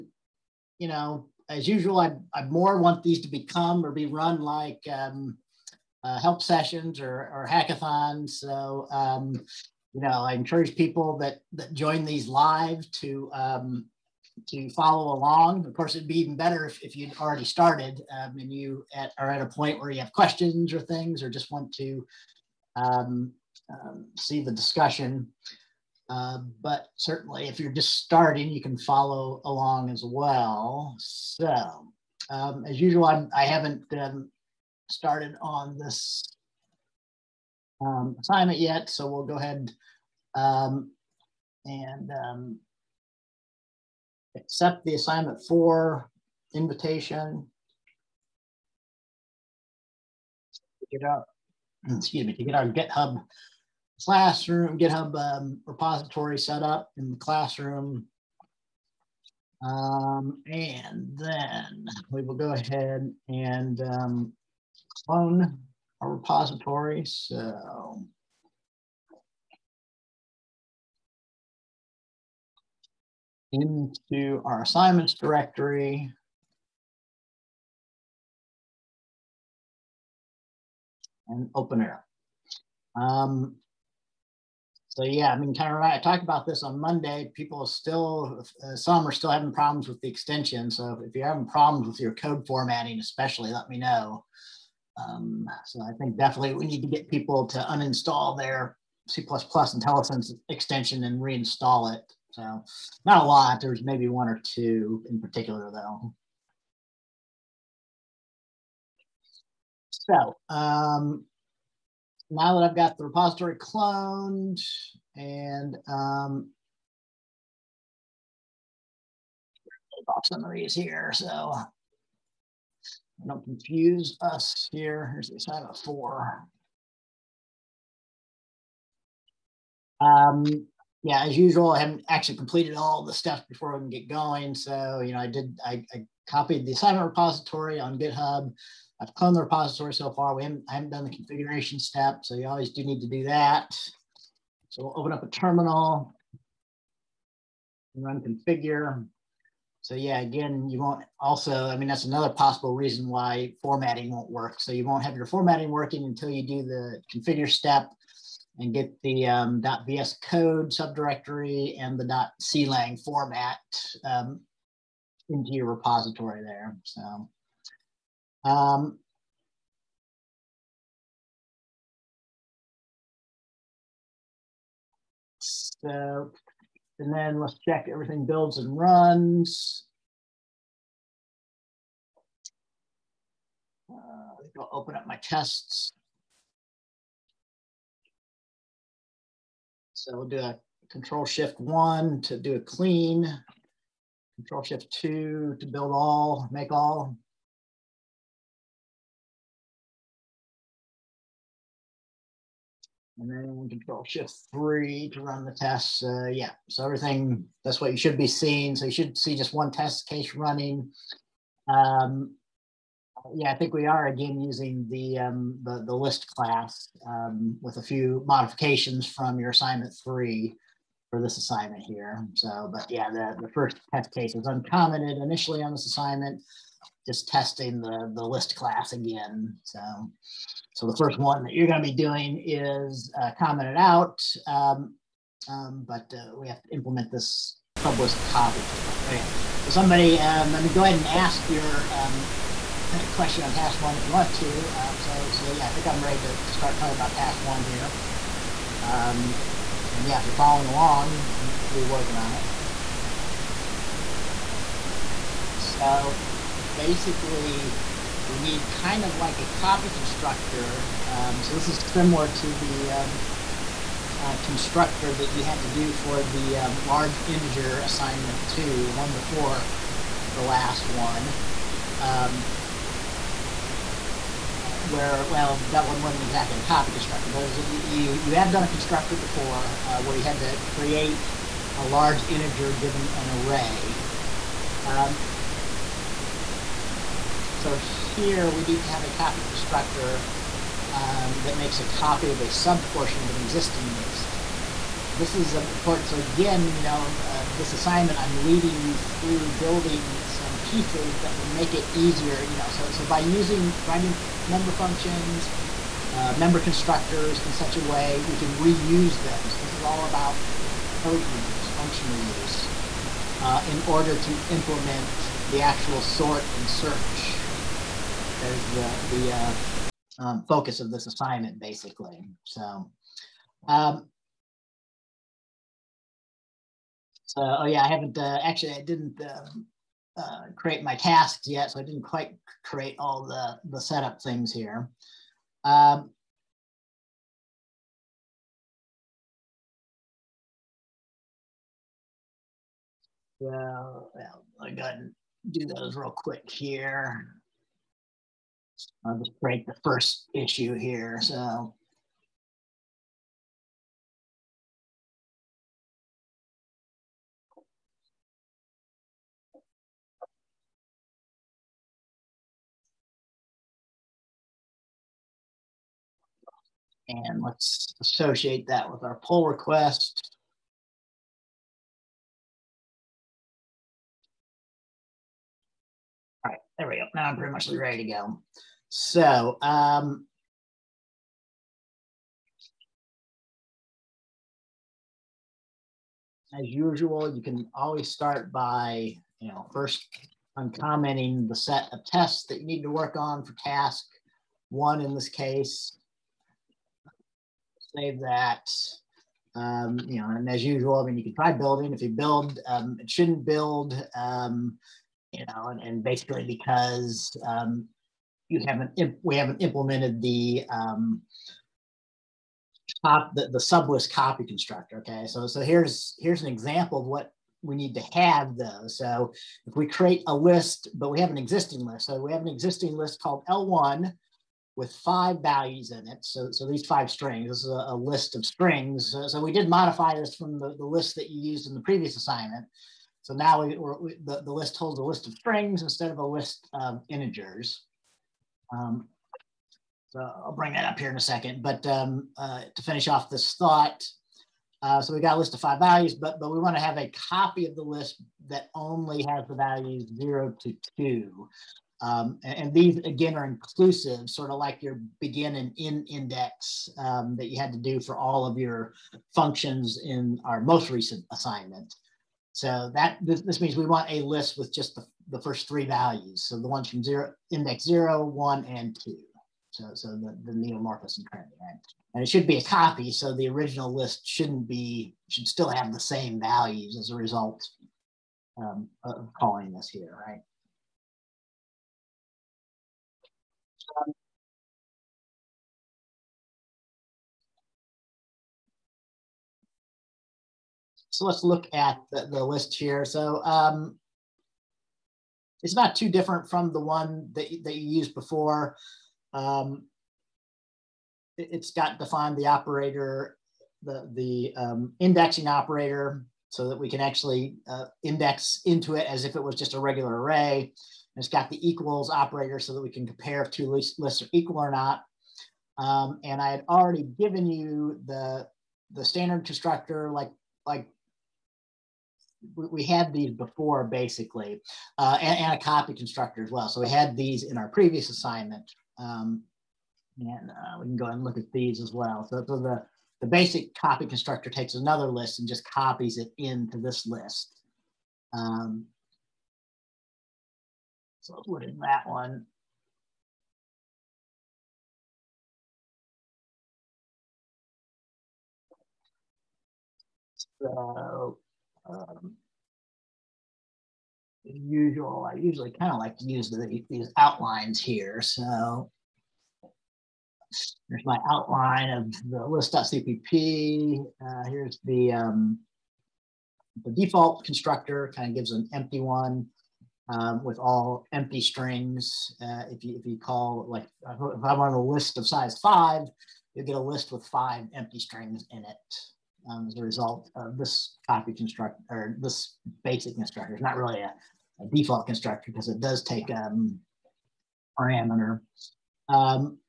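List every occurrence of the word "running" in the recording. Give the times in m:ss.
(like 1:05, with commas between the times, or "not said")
3:30.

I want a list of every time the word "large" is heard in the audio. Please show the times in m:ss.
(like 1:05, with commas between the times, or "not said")
4:26, 4:41.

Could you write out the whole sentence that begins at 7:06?
So, so these five strings, this is a, a list of strings.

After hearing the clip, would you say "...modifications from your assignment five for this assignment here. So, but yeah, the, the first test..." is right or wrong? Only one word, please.
wrong.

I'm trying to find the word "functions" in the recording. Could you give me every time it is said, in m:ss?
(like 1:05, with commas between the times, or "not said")
5:04, 5:11, 7:39.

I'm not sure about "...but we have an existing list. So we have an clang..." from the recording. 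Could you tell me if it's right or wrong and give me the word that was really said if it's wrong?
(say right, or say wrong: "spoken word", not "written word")
wrong: "existing", not "clang".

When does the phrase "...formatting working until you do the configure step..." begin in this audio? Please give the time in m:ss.
2:35.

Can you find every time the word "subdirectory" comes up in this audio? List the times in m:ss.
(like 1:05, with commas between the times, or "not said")
2:40.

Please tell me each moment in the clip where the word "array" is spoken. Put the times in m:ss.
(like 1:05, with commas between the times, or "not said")
4:43, 8:30.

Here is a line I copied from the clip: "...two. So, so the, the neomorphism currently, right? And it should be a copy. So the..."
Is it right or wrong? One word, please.
right.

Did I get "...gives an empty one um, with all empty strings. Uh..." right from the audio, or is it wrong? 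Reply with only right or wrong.
right.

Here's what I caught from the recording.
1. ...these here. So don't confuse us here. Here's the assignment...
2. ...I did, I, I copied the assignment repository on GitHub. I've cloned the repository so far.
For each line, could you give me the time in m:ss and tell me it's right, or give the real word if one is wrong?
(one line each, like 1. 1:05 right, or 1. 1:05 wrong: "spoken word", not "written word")
1. 2:00 right
2. 2:15 right.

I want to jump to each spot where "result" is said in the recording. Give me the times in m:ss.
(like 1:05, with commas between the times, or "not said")
7:57, 9:39.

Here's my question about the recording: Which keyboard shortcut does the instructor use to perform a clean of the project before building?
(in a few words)
Control Shift 1.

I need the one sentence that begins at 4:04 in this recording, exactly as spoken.
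Um, so, so yeah, I think I'm ready to, to start talking about task one here.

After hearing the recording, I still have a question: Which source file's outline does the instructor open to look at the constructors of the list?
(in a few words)
list.cpp.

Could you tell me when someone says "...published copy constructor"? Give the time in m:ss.
3:57.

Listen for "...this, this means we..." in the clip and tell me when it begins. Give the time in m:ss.
7:43.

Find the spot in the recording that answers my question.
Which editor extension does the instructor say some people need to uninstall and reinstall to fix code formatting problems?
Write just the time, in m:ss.
1:39.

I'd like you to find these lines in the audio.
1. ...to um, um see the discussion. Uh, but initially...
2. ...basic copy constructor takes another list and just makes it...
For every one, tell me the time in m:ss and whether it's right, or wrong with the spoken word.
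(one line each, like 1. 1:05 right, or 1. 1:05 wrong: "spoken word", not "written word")
1. 0:21 wrong: "certainly", not "initially"
2. 8:53 wrong: "copies", not "makes".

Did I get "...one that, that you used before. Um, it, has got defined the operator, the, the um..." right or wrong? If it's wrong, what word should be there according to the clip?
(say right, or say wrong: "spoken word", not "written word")
right.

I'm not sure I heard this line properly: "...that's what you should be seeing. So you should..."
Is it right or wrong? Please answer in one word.
right.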